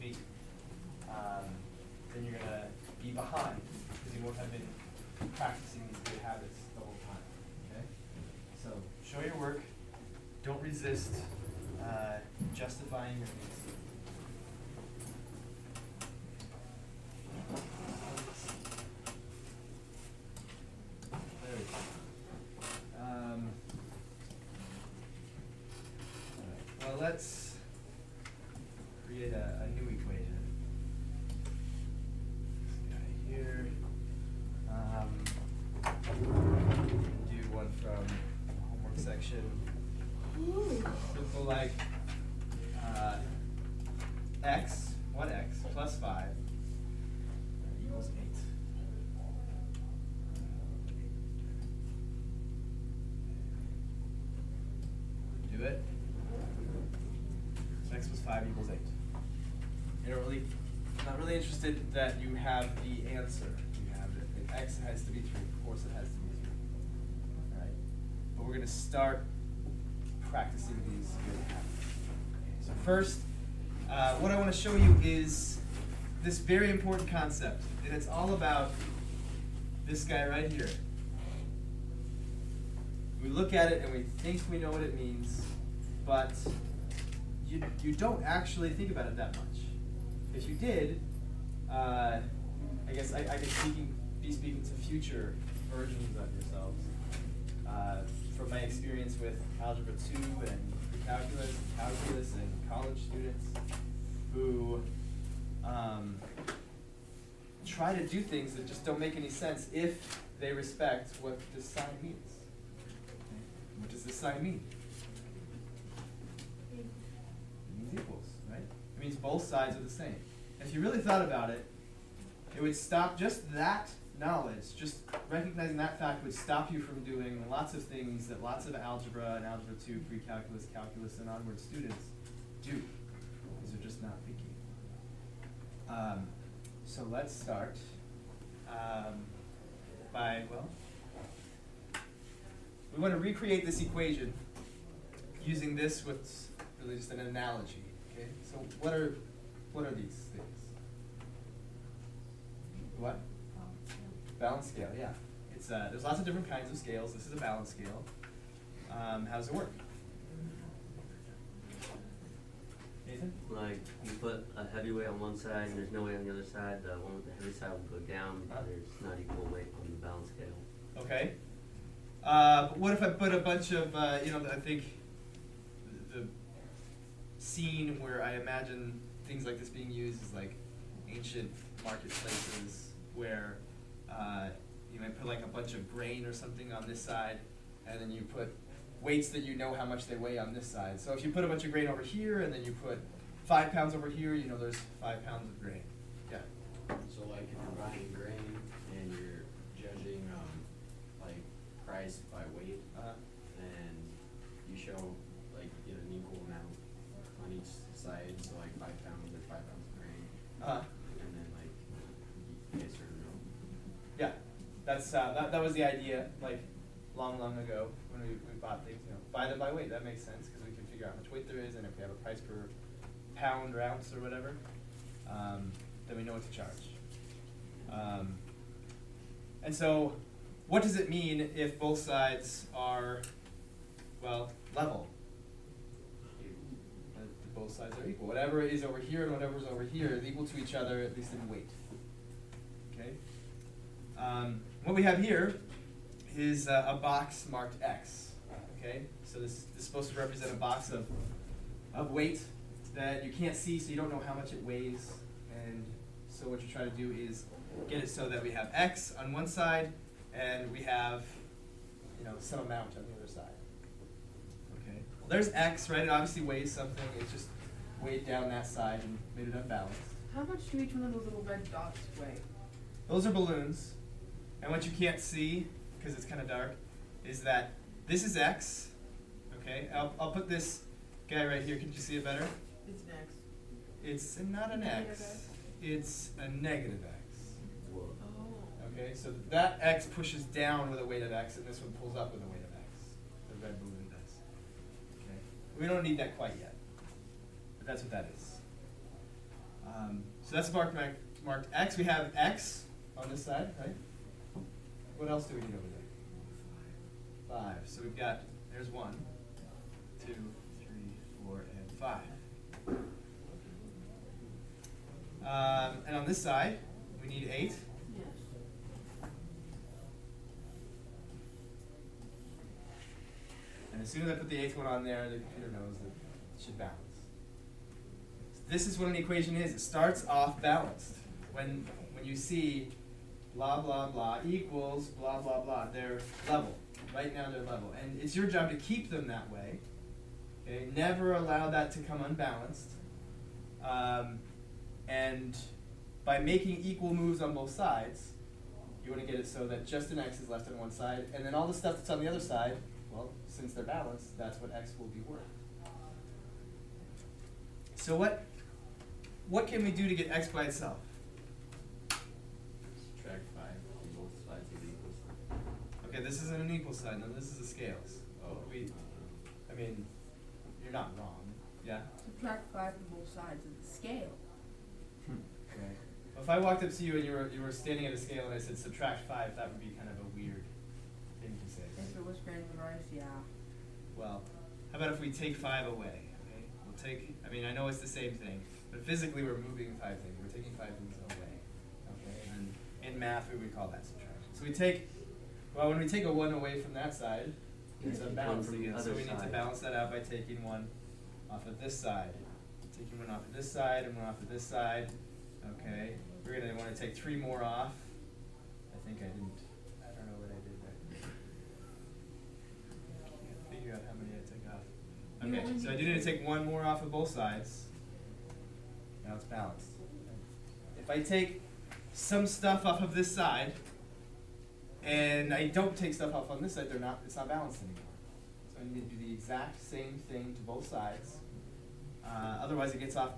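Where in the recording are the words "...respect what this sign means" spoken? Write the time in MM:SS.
01:50.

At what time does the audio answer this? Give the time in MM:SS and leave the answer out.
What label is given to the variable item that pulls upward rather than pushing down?
04:46.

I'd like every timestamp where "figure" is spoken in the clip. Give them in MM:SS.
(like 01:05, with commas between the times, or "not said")
03:40, 06:53.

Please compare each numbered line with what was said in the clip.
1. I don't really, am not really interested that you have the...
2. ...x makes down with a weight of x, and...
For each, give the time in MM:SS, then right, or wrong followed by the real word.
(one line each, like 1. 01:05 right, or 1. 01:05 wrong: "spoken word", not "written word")
1. 01:00 right
2. 04:49 wrong: "pushes", not "makes".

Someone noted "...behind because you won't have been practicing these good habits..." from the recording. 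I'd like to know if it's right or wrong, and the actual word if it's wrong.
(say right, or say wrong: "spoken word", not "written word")
right.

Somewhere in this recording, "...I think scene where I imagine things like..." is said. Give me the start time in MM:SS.
02:54.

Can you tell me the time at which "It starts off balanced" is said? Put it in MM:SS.
05:29.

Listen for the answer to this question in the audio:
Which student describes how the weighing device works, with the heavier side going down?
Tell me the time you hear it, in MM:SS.
02:43.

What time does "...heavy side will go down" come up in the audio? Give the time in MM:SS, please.
02:47.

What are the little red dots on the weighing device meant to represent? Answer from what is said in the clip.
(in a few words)
Balloons.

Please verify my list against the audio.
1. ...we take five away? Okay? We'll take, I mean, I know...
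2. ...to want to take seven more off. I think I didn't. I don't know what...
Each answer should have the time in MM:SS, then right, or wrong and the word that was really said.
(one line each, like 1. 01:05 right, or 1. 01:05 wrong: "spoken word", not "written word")
1. 06:25 right
2. 06:46 wrong: "three", not "seven".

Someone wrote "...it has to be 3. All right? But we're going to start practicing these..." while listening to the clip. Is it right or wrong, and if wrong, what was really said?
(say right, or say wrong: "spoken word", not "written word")
right.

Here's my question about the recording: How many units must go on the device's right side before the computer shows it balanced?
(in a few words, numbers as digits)
8.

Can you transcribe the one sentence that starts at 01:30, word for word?
If you did, uh, I guess I, I could speaking, be speaking to future versions of yourselves.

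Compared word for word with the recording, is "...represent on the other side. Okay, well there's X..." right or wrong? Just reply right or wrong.
wrong.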